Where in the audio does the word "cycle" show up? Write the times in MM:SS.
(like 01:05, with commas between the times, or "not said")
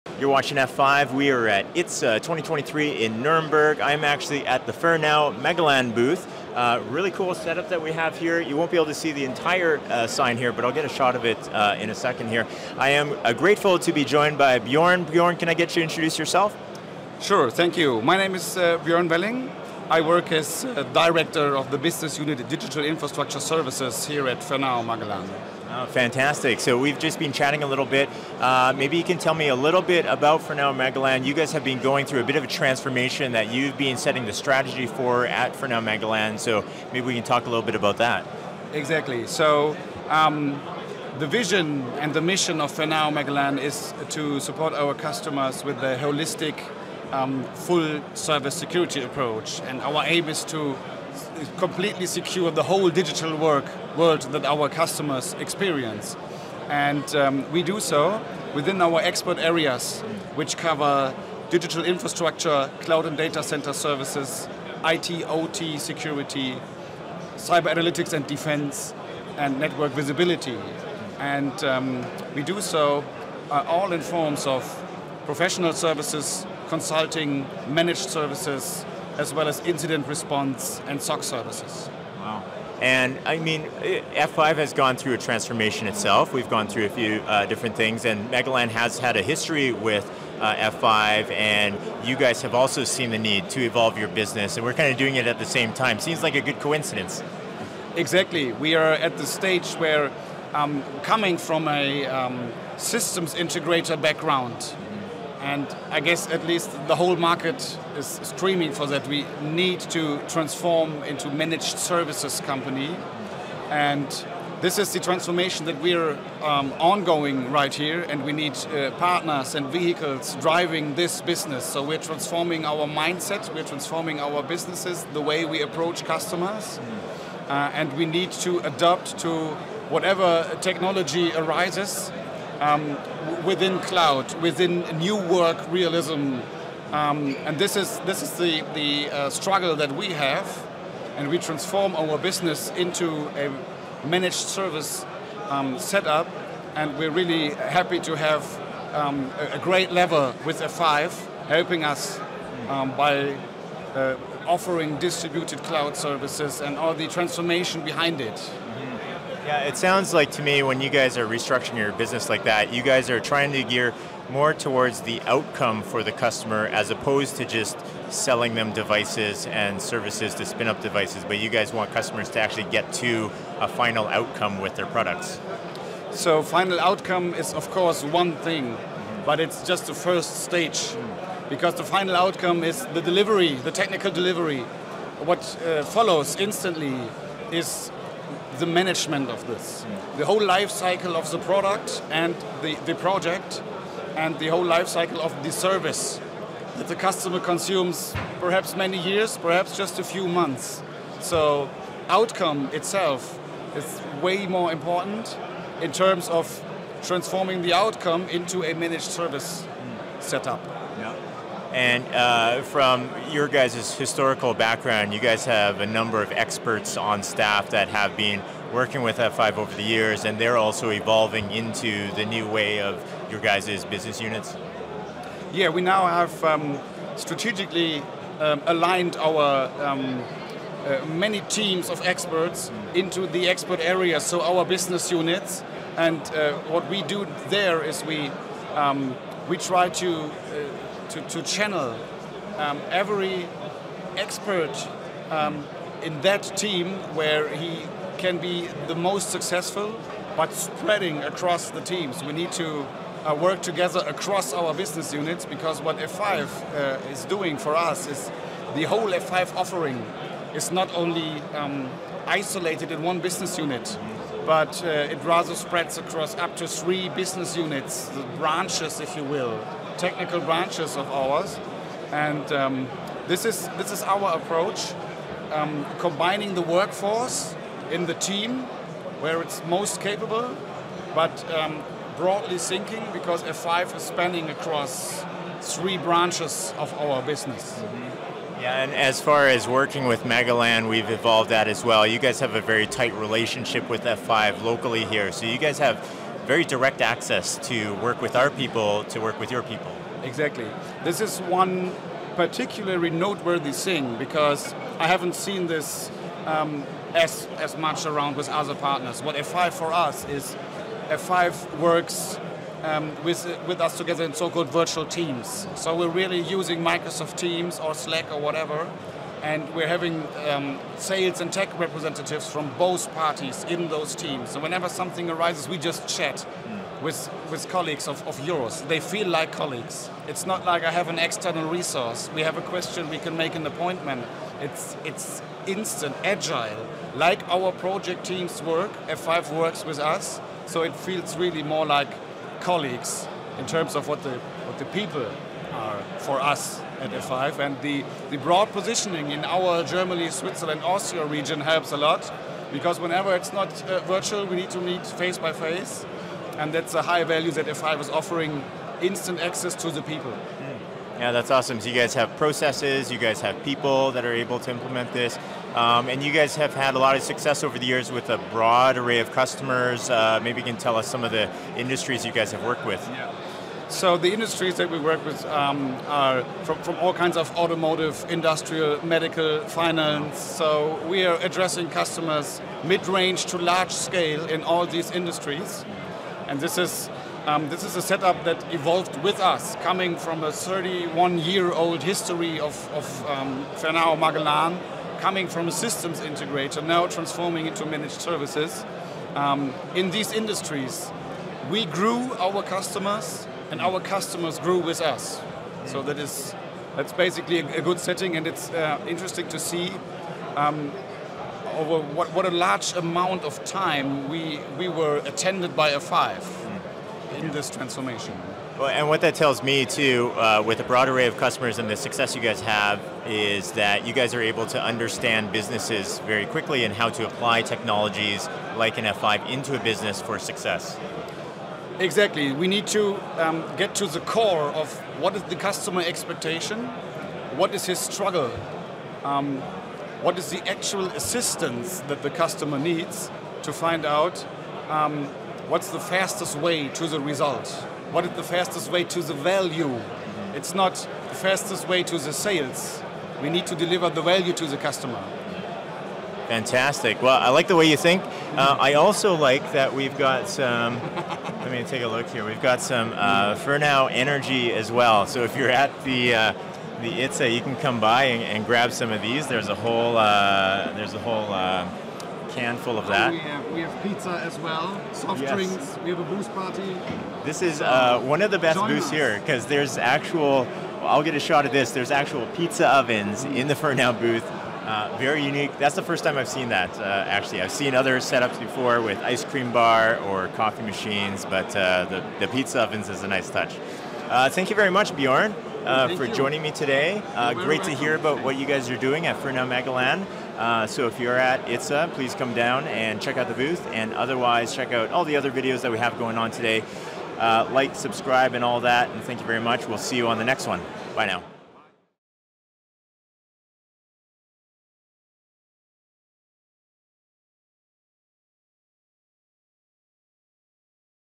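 03:10, 03:14.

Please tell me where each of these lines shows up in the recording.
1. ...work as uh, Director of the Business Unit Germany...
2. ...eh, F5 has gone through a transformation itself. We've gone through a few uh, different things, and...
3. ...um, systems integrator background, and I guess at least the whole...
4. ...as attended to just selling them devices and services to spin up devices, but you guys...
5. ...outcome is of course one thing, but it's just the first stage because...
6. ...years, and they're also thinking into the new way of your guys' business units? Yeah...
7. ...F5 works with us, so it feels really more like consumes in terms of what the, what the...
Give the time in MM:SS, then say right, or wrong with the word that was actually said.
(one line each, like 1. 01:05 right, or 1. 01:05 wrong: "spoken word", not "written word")
1. 00:20 wrong: "Digital", not "Germany"
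2. 01:23 right
3. 01:42 right
4. 02:46 wrong: "opposed", not "attended"
5. 02:56 right
6. 03:39 wrong: "evolving", not "thinking"
7. 05:39 wrong: "colleagues", not "consumes".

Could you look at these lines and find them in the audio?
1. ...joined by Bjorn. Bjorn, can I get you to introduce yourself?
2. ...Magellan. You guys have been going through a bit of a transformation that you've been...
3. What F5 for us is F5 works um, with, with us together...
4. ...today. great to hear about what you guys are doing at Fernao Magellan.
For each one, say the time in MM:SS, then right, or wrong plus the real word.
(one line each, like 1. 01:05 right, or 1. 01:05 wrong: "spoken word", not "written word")
1. 00:14 right
2. 00:30 right
3. 05:09 right
4. 08:16 right.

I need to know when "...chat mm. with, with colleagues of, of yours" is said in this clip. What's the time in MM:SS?
05:26.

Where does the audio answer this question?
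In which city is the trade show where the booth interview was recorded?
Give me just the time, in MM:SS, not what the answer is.
00:03.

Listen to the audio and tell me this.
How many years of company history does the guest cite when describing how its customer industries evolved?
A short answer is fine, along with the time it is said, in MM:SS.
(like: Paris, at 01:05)
31, at 06:30.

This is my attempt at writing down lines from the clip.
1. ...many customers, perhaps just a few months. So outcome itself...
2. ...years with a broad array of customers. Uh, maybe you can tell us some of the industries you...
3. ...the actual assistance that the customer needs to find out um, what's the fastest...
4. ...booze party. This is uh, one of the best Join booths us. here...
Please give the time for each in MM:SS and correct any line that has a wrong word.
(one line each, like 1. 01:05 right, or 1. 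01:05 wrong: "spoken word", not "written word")
1. 03:18 wrong: "years", not "customers"
2. 06:07 right
3. 07:20 right
4. 07:56 right.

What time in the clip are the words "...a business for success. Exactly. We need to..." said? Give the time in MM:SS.
07:09.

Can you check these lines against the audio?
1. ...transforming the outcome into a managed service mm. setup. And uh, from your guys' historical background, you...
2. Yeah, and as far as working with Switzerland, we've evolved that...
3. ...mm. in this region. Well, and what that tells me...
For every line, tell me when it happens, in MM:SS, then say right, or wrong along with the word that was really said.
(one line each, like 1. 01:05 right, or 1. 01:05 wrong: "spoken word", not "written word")
1. 03:27 right
2. 04:48 wrong: "Magellan", not "Switzerland"
3. 06:56 wrong: "transformation", not "region".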